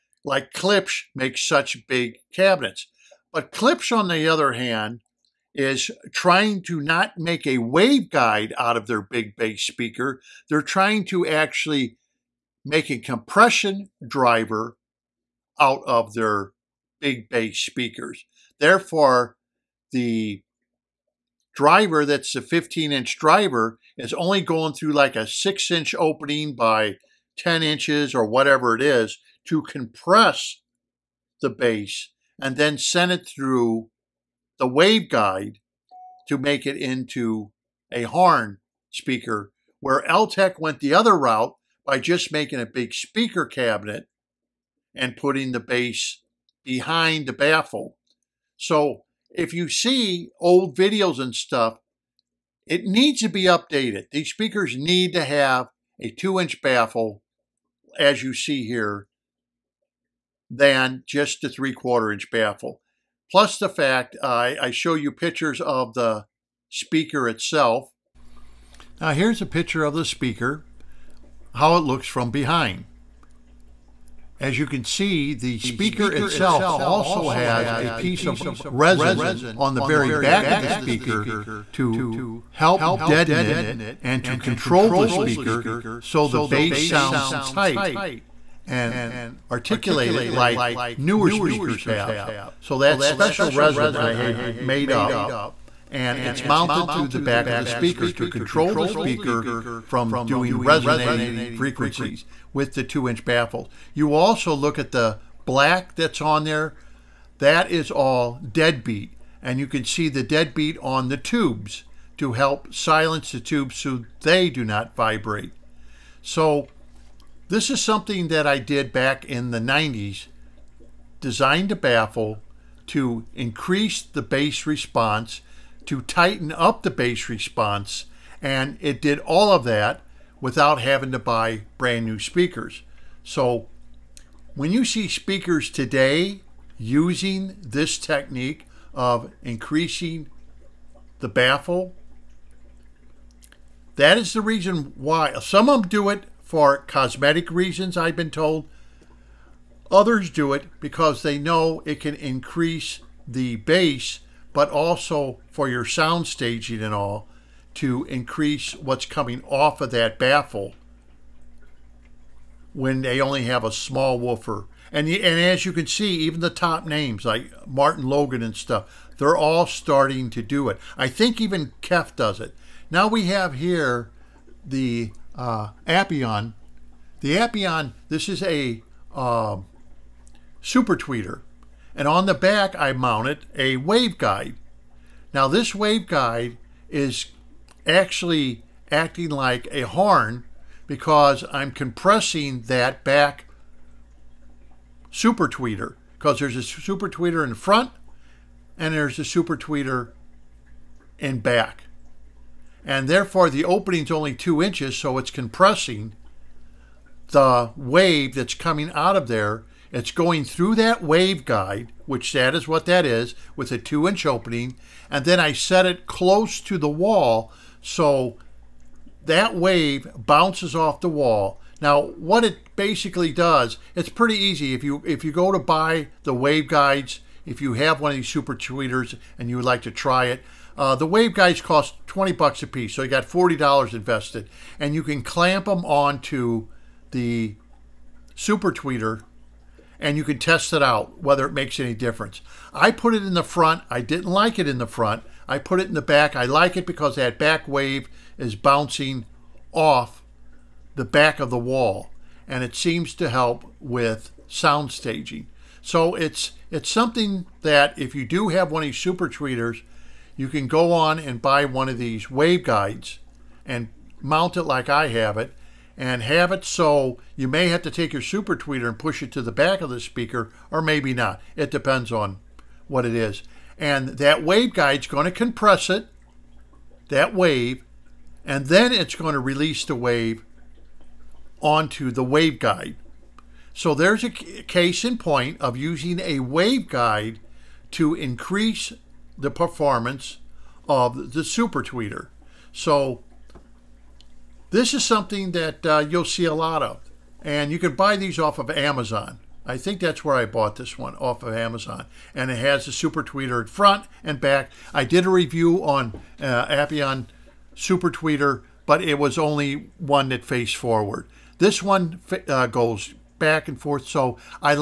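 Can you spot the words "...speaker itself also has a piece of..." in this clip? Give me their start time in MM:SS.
01:15.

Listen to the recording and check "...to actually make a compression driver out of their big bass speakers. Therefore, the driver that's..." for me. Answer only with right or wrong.
right.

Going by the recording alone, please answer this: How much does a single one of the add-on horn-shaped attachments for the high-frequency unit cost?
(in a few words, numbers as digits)
$20.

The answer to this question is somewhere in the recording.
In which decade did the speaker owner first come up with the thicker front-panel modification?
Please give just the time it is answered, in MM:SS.
01:59.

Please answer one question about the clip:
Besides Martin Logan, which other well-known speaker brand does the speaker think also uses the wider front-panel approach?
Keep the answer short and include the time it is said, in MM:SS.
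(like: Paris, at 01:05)
KEF, at 02:51.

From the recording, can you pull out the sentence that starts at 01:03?
Plus the fact I, I show you pictures of the speaker itself.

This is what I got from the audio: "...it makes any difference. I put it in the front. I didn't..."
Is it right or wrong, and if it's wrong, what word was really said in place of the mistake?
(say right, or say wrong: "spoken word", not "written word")
right.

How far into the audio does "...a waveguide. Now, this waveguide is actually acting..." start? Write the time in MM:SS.
03:03.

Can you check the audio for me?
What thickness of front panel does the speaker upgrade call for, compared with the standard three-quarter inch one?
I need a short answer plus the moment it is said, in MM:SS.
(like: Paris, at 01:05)
2 inches, at 00:56.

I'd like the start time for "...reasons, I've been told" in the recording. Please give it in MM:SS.
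02:27.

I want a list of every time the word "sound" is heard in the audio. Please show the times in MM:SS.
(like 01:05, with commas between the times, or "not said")
01:26, 02:35, 04:14.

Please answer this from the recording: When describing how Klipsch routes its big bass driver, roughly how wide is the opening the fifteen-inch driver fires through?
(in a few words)
6 inches.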